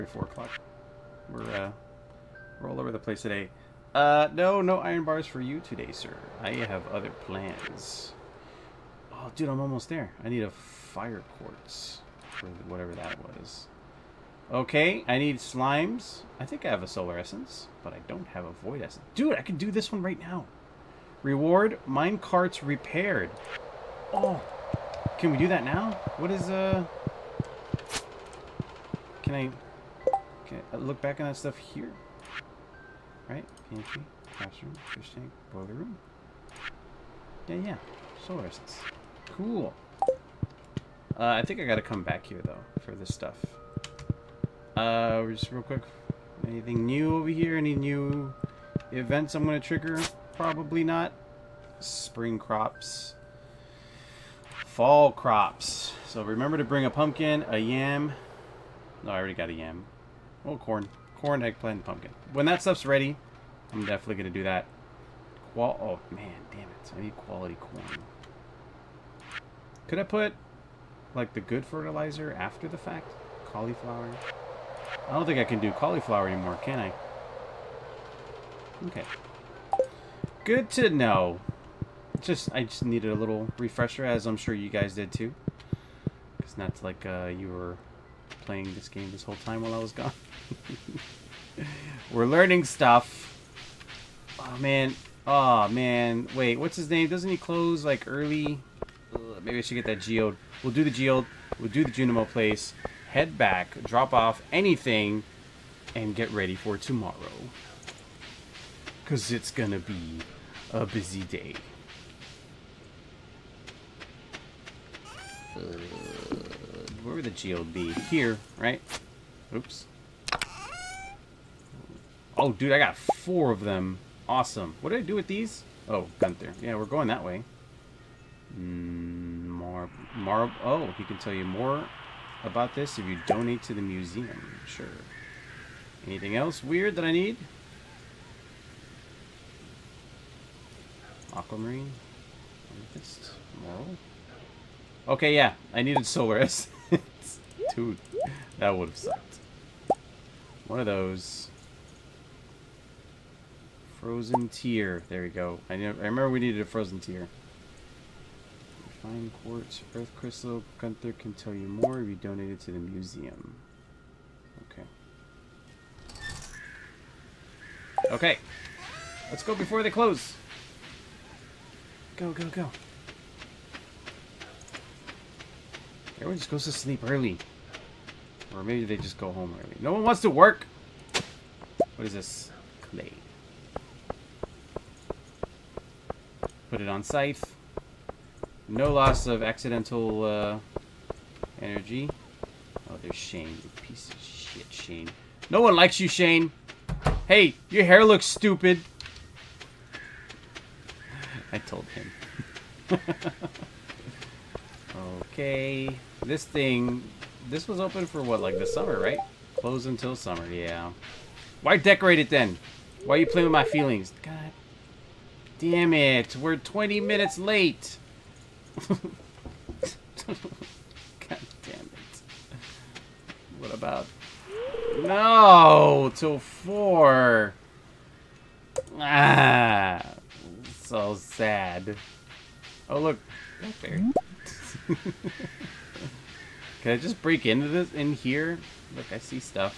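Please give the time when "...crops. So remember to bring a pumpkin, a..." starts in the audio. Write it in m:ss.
0:55.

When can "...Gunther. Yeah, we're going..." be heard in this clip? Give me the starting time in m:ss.
2:06.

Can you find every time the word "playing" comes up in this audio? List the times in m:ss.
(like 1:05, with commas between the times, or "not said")
1:28, 3:33.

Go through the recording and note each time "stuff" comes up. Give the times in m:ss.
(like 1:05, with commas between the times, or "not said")
0:31, 0:43, 1:02, 1:32.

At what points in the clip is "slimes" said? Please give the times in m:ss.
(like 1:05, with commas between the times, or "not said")
0:15.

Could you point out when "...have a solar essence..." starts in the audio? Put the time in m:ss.
0:16.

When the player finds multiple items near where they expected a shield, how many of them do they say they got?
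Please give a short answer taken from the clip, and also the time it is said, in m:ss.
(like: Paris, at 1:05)
4, at 2:02.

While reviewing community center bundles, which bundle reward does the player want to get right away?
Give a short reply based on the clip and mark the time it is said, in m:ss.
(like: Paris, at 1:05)
Mine carts repaired, at 0:21.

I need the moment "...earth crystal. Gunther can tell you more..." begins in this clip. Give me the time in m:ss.
2:39.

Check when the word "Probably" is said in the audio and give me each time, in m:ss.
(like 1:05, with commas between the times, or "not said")
0:50.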